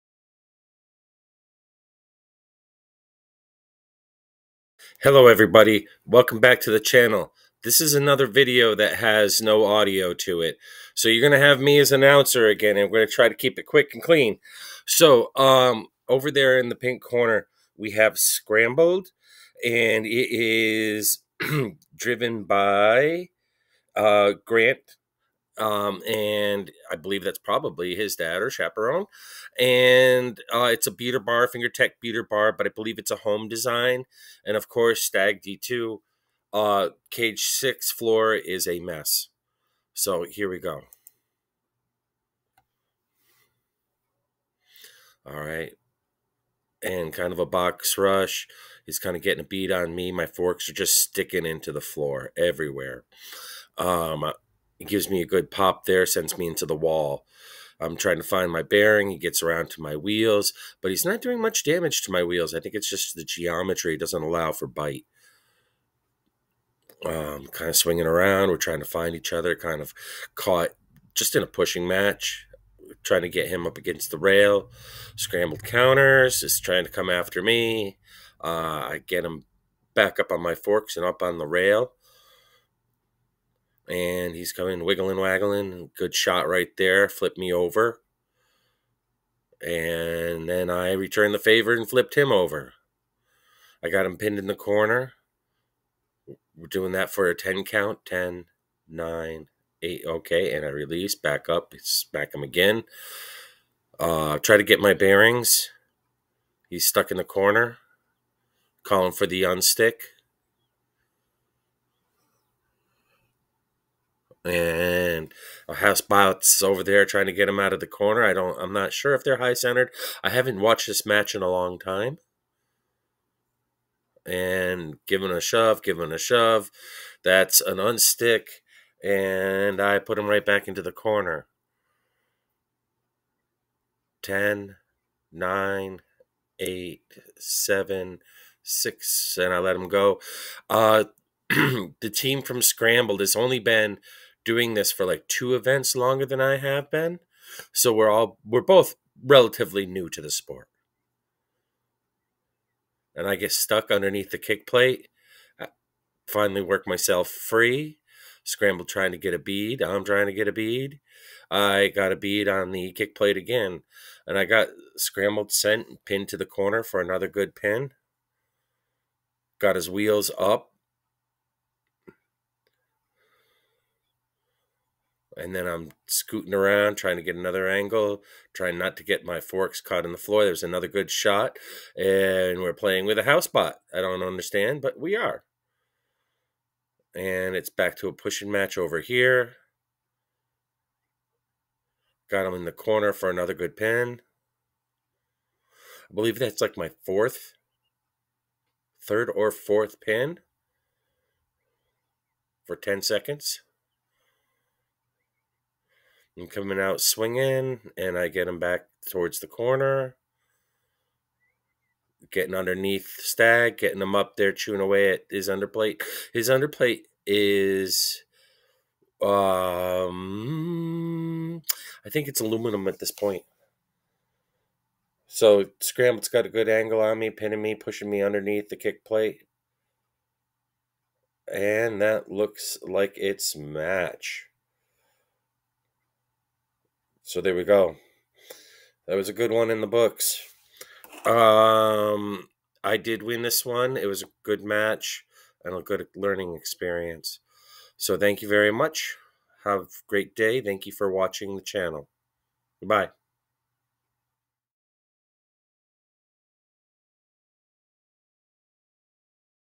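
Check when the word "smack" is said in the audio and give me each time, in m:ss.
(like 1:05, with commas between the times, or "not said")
1:41.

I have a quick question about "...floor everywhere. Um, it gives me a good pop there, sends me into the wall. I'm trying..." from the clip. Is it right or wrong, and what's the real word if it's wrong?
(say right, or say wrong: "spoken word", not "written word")
right.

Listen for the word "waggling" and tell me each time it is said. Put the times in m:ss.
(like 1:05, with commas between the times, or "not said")
1:25.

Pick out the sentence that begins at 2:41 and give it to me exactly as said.
I got a bead on the kick plate again.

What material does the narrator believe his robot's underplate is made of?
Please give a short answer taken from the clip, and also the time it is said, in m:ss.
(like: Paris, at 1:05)
Aluminum, at 3:42.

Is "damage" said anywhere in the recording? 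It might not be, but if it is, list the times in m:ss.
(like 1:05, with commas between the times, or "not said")
1:01.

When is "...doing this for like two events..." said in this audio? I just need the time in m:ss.
2:24.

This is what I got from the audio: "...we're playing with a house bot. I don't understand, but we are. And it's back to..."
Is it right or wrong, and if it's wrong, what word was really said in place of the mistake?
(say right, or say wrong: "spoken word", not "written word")
right.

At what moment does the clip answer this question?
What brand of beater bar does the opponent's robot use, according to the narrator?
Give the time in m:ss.
0:31.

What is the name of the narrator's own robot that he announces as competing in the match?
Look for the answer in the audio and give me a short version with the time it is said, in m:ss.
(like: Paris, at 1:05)
Stag D2, at 0:35.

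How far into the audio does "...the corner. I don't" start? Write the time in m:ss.
1:57.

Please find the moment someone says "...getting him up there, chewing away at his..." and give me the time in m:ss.
3:33.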